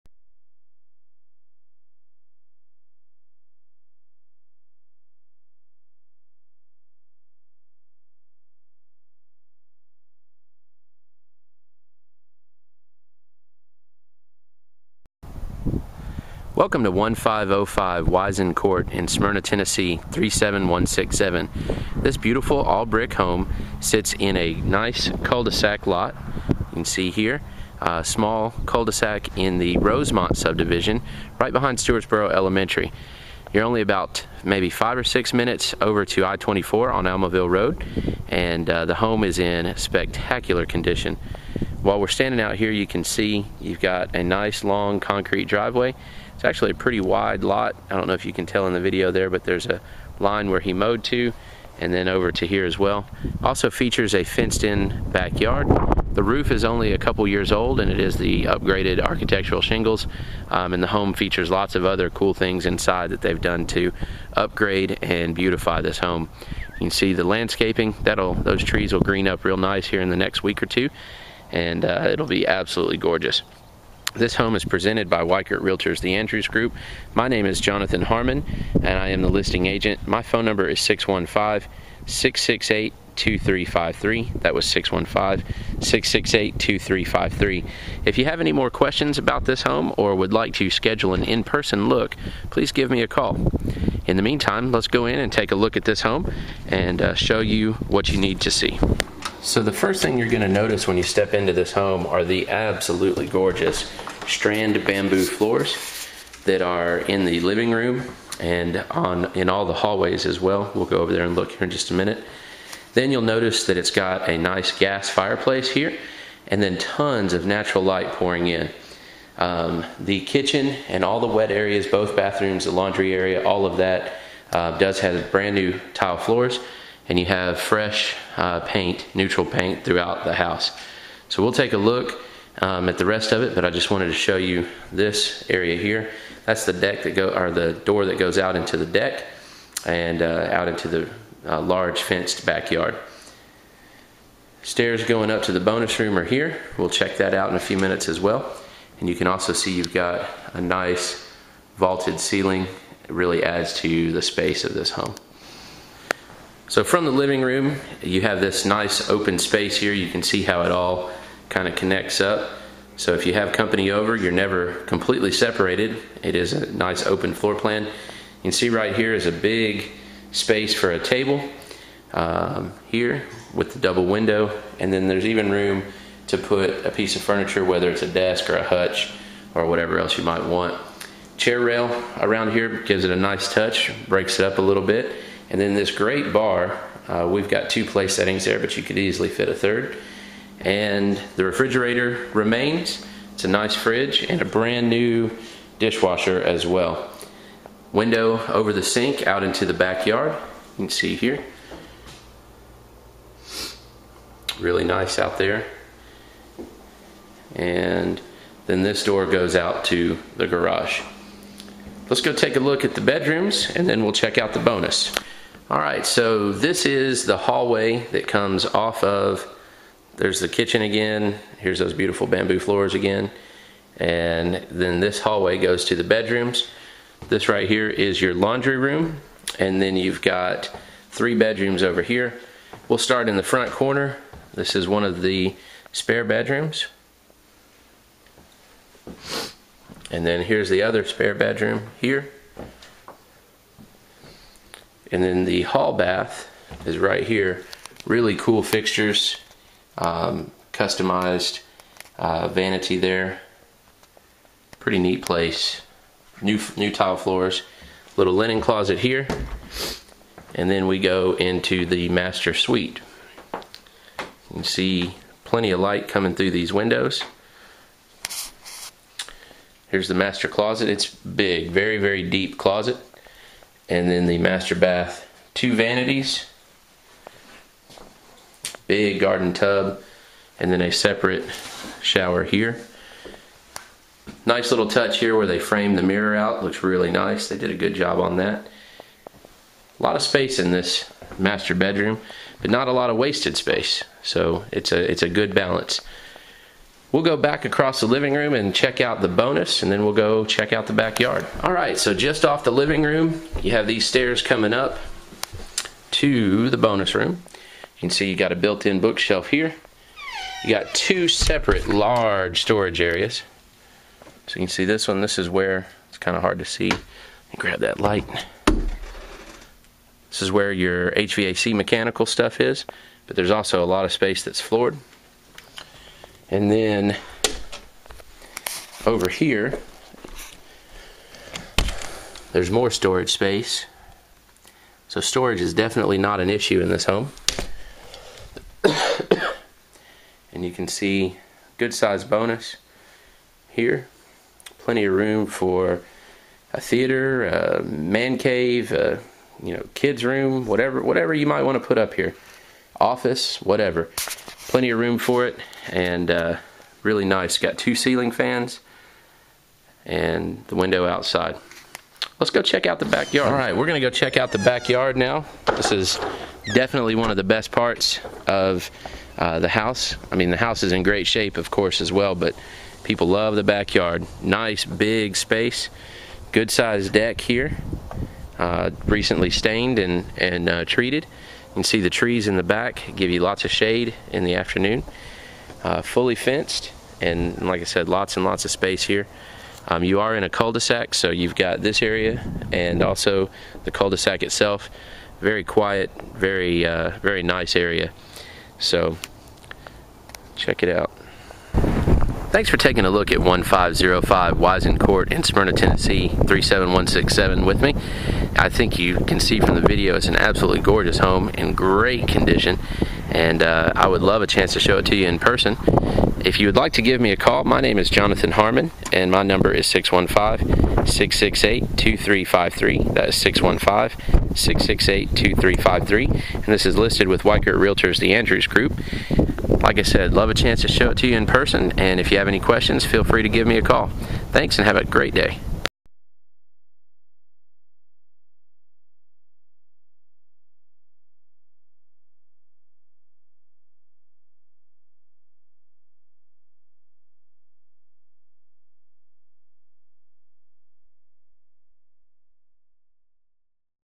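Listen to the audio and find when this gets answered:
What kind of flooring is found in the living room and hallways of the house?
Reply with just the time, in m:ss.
1:44.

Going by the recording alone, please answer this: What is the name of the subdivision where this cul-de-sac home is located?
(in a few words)
Rosemont.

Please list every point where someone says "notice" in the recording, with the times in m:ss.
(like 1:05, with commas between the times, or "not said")
1:40, 1:53.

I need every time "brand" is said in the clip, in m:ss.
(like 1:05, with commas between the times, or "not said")
2:05, 3:14.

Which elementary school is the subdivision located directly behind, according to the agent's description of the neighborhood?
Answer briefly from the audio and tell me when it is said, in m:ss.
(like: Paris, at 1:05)
Stewartsboro Elementary, at 0:31.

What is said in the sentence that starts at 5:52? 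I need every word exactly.
Office, whatever plenty of room for it and uh, really nice.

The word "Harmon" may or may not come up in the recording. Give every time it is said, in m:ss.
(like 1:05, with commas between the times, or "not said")
1:18, 6:58.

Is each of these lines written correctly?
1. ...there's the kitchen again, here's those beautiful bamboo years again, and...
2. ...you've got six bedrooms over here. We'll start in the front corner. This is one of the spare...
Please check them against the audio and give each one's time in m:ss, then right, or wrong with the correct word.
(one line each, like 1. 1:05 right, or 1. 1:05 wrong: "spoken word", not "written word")
1. 3:40 wrong: "floors", not "years"
2. 3:49 wrong: "three", not "six".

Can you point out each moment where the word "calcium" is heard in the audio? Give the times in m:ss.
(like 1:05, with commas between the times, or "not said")
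not said.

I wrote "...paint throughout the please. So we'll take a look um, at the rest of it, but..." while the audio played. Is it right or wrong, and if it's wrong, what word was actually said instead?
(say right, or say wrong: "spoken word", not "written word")
wrong: "house", not "please".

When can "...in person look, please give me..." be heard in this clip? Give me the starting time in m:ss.
1:31.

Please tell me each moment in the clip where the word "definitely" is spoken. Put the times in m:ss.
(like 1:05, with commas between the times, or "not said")
5:35, 6:06.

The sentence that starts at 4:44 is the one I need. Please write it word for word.
Nice little touch here where they framed the mirror out.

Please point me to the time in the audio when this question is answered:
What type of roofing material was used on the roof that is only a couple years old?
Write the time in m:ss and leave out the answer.
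0:58.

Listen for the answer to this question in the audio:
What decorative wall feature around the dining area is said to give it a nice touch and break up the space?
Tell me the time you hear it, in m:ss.
3:01.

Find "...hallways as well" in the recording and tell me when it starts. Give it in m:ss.
1:49.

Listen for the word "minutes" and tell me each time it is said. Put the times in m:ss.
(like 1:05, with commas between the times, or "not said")
0:35, 1:51, 2:27.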